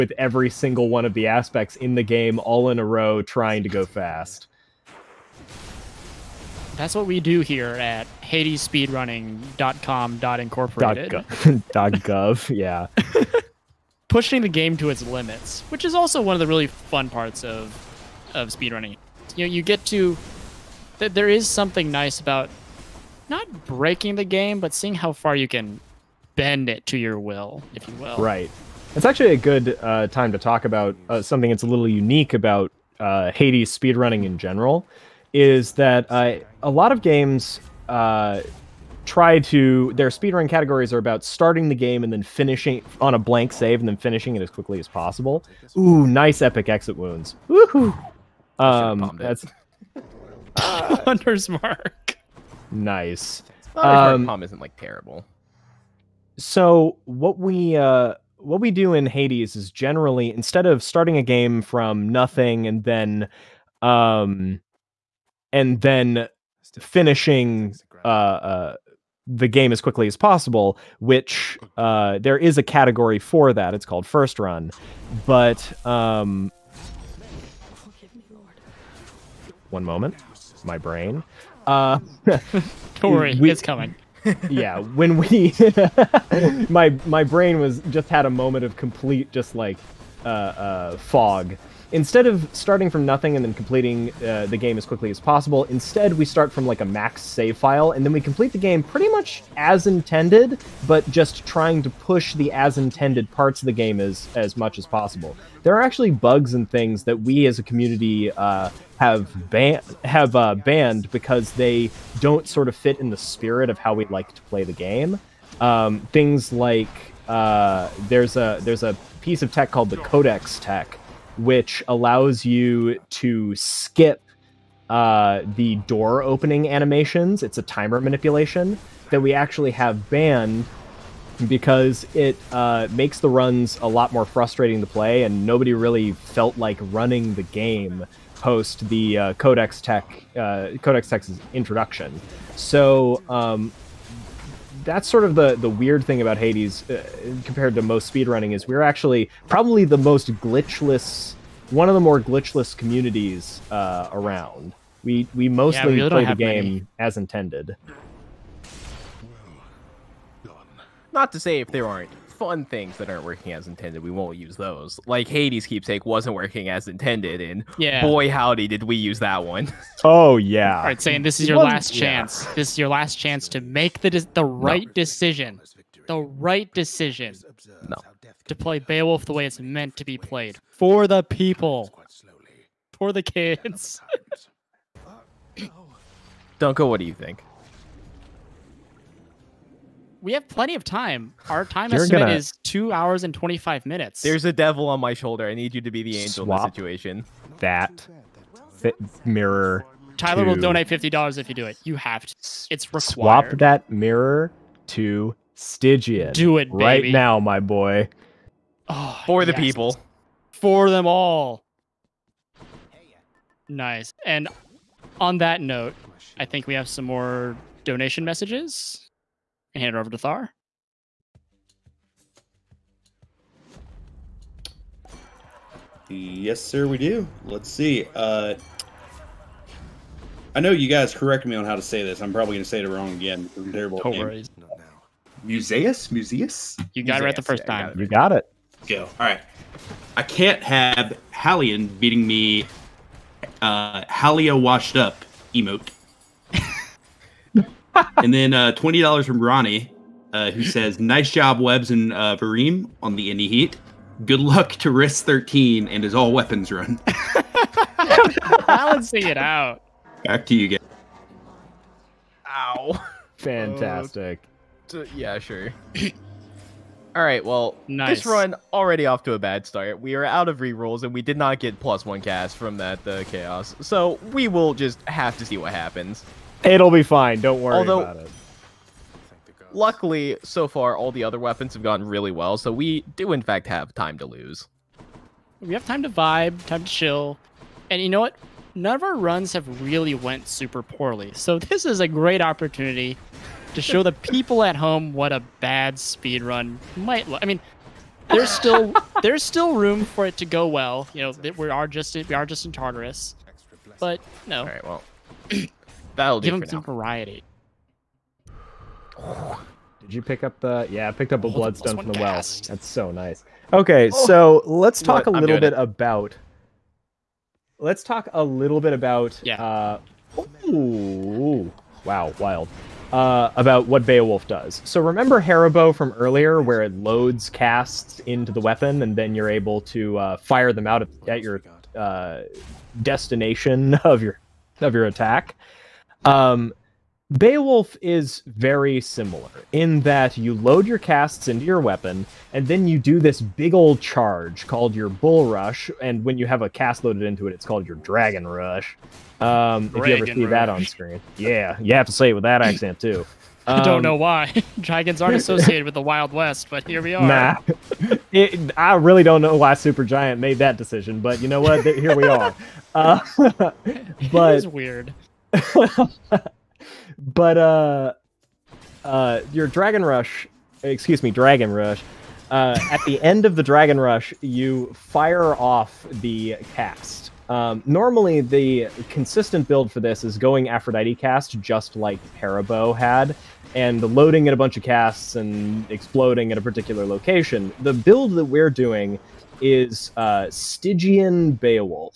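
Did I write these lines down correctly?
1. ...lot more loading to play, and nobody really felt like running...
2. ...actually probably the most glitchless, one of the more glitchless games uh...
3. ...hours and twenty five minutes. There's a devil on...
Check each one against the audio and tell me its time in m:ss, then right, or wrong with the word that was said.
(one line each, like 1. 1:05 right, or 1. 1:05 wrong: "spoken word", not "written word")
1. 2:13 wrong: "frustrating", not "loading"
2. 2:28 wrong: "communities", not "games"
3. 3:12 right.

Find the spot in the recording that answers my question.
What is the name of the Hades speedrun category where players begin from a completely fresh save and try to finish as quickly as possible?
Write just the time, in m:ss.
1:14.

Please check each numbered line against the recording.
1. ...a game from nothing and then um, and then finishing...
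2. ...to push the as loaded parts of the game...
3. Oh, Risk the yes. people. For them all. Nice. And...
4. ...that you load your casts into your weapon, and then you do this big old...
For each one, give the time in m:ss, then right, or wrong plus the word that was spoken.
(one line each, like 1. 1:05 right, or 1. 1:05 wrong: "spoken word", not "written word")
1. 1:01 right
2. 1:41 wrong: "intended", not "loaded"
3. 3:28 wrong: "For", not "Risk"
4. 5:40 right.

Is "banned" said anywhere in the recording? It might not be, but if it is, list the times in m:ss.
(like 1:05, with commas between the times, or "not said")
1:50, 2:10.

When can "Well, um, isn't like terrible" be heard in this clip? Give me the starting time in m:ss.
0:53.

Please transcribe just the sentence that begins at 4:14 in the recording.
Good luck to Risk Thirteen and his all weapons run.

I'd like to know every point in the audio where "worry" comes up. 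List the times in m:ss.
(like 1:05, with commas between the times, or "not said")
1:23, 3:54, 4:37.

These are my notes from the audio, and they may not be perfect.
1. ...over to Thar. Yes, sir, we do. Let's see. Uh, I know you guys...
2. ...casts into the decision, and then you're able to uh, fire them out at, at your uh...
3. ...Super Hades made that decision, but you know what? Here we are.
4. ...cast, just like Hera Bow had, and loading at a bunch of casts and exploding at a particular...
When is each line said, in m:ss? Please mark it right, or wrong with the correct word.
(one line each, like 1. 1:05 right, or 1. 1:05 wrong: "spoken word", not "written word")
1. 3:39 right
2. 5:27 wrong: "weapon", not "decision"
3. 5:59 wrong: "Giant", not "Hades"
4. 6:21 right.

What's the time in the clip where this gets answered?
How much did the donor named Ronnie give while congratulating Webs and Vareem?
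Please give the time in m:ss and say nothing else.
4:08.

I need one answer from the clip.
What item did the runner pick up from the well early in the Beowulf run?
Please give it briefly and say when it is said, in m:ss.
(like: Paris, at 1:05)
Bloodstone, at 5:11.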